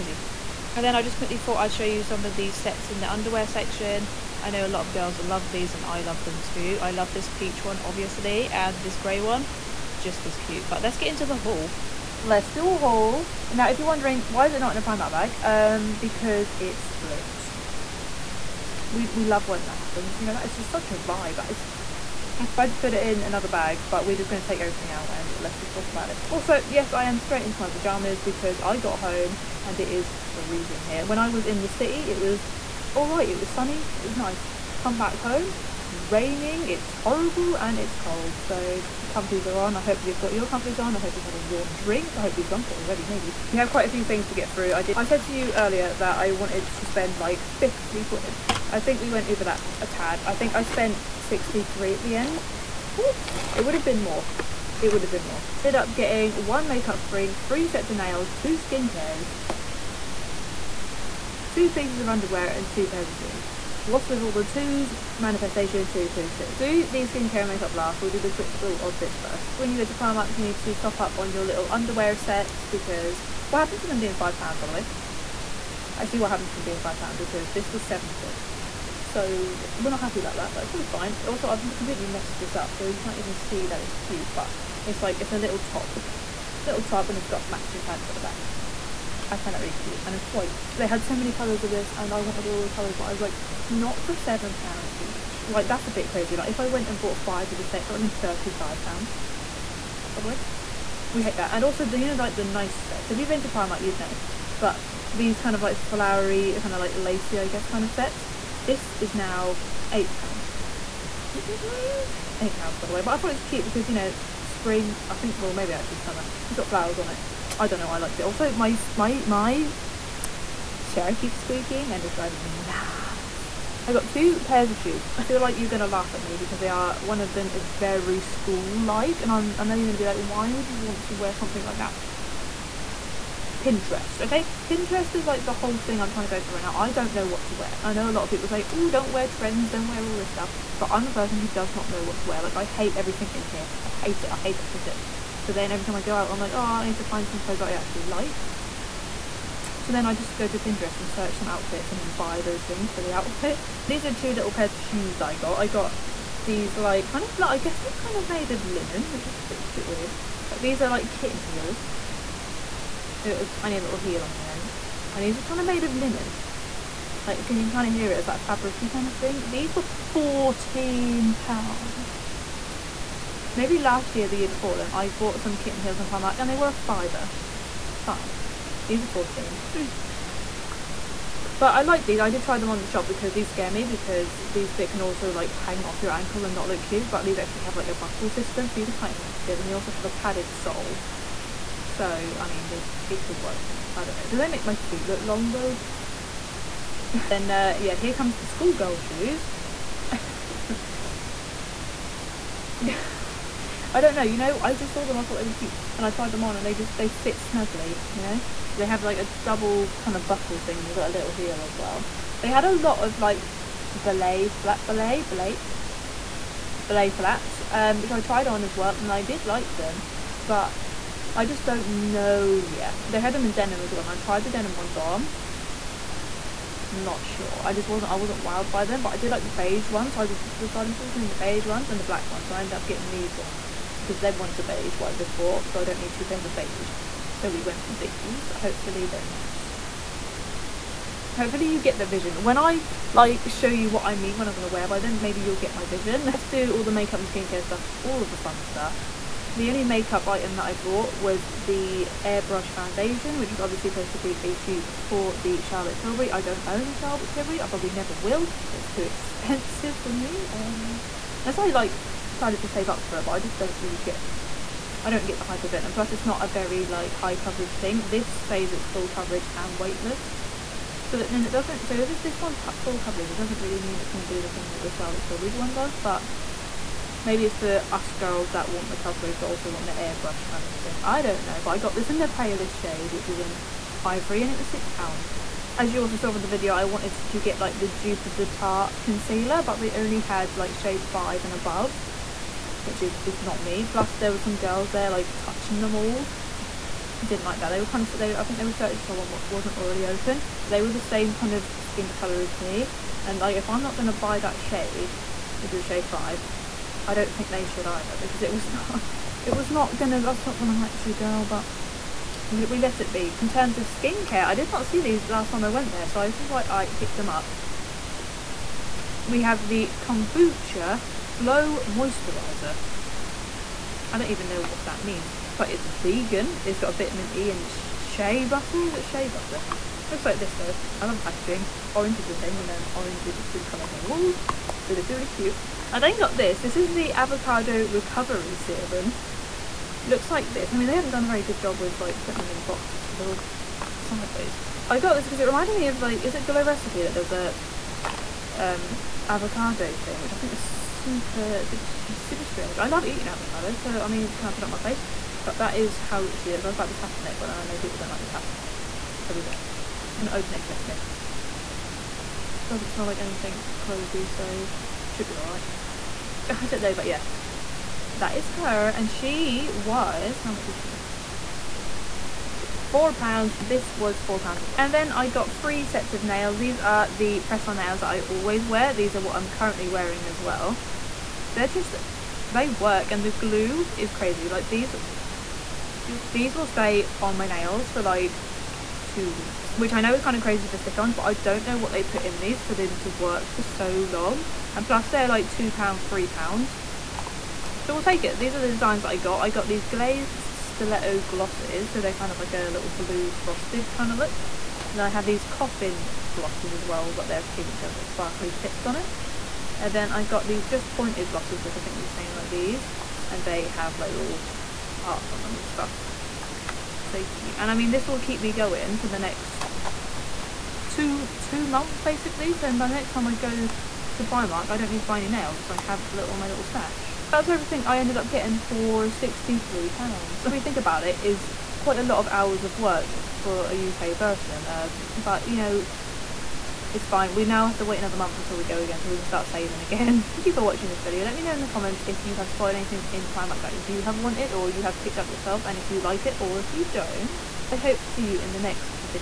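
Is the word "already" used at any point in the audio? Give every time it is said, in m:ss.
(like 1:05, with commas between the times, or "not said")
0:42, 4:59.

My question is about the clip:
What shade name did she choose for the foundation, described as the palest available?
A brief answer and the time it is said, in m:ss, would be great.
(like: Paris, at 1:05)
Ivory, at 4:44.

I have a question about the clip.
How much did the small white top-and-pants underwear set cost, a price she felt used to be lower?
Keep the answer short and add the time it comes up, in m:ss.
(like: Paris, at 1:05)
£7, at 1:17.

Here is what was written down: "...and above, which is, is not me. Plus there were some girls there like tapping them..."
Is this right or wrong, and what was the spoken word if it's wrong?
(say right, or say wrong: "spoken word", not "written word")
wrong: "touching", not "tapping".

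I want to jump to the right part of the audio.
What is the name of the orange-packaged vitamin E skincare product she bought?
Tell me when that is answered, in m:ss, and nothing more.
5:20.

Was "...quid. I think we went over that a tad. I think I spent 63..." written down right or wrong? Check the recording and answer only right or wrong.
right.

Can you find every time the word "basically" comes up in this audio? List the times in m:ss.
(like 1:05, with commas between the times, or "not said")
7:02.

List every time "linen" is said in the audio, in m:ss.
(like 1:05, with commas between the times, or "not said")
2:38, 2:45.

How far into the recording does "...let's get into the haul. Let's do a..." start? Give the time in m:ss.
0:10.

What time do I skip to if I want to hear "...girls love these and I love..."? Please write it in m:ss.
0:04.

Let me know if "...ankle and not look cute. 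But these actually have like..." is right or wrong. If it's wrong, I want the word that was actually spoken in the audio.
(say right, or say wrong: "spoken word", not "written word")
right.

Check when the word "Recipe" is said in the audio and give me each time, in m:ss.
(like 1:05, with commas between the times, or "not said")
5:46.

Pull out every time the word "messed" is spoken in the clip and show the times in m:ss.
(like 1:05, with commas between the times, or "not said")
1:22.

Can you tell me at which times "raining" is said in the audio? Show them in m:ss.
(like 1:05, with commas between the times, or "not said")
0:35.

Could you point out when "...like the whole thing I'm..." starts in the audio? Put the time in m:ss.
2:15.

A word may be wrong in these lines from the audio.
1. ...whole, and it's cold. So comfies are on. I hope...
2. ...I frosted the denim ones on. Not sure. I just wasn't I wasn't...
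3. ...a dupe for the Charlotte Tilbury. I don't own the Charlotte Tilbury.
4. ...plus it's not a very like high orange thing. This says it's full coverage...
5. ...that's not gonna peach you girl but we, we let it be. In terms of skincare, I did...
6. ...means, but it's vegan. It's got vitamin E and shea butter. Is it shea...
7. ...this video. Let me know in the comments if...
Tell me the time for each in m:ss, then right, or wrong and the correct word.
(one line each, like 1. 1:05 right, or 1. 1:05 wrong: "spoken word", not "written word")
1. 0:36 wrong: "horrible", not "whole"
2. 3:44 wrong: "tried", not "frosted"
3. 4:14 right
4. 4:25 wrong: "coverage", not "orange"
5. 5:10 wrong: "match", not "peach"
6. 5:25 right
7. 7:20 right.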